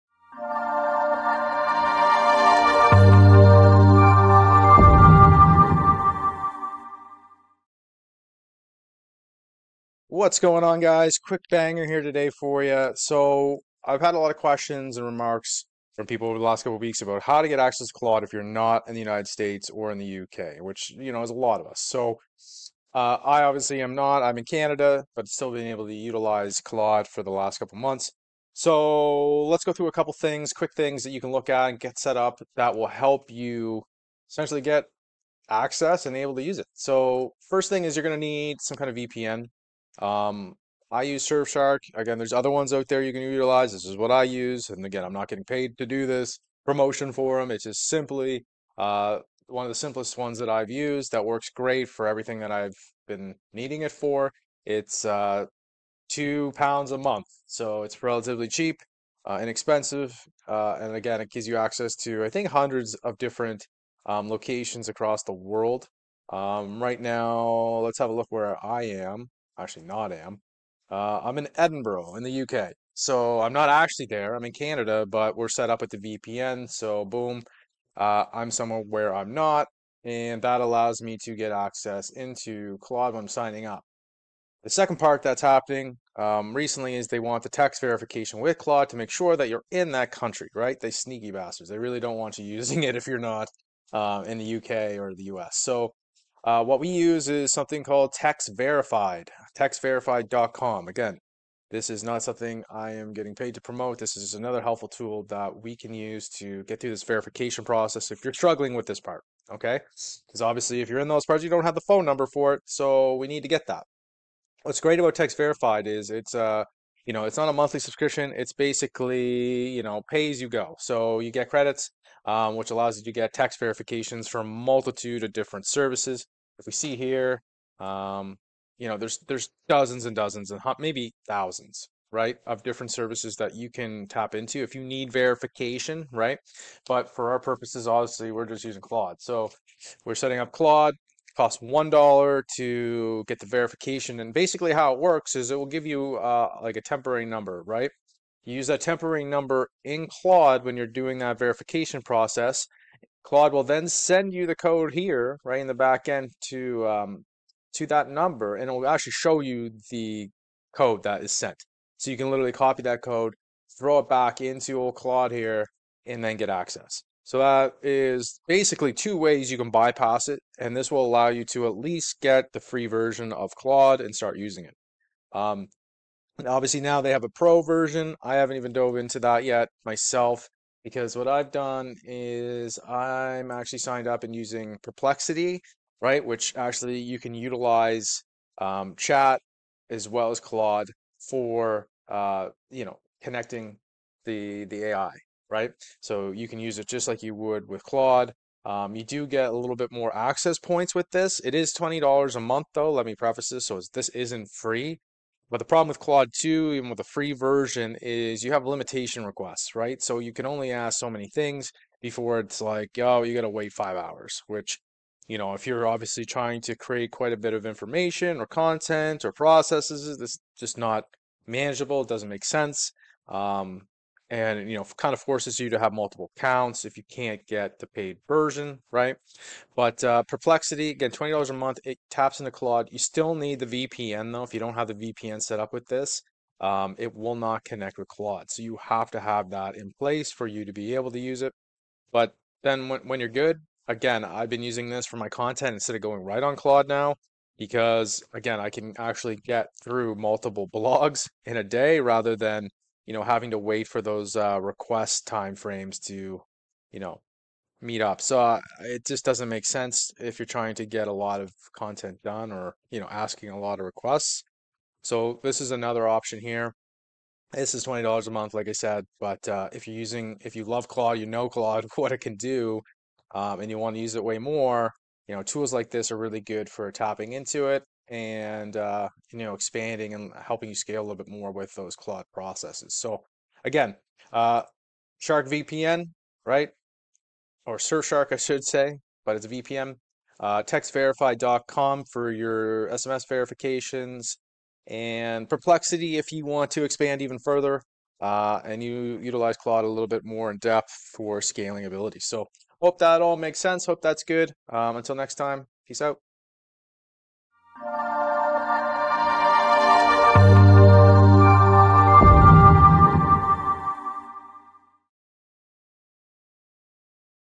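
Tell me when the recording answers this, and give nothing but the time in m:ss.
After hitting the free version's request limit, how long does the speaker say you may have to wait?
3:33.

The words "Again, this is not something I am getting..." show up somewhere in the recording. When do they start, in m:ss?
1:40.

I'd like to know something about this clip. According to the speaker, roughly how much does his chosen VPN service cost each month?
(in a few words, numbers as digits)
2 pounds.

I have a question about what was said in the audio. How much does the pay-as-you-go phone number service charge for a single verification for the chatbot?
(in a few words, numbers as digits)
1 dollar.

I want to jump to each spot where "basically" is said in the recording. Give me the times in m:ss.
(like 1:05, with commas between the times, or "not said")
1:58, 2:24, 2:48.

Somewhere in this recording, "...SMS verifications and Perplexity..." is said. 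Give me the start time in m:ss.
4:52.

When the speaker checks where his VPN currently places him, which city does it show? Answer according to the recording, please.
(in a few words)
Edinburgh.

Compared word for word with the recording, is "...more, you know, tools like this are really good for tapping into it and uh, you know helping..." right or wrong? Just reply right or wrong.
wrong.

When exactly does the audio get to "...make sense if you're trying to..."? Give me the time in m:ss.
4:19.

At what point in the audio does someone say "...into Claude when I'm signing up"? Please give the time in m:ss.
1:22.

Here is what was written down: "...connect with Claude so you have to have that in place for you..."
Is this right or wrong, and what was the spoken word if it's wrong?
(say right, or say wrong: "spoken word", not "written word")
right.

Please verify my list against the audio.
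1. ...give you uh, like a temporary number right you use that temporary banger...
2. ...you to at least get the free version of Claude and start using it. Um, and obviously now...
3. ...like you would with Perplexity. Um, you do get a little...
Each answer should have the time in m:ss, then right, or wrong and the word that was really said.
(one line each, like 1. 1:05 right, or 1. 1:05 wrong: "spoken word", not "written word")
1. 2:25 wrong: "number", not "banger"
2. 2:51 right
3. 3:17 wrong: "Claude", not "Perplexity".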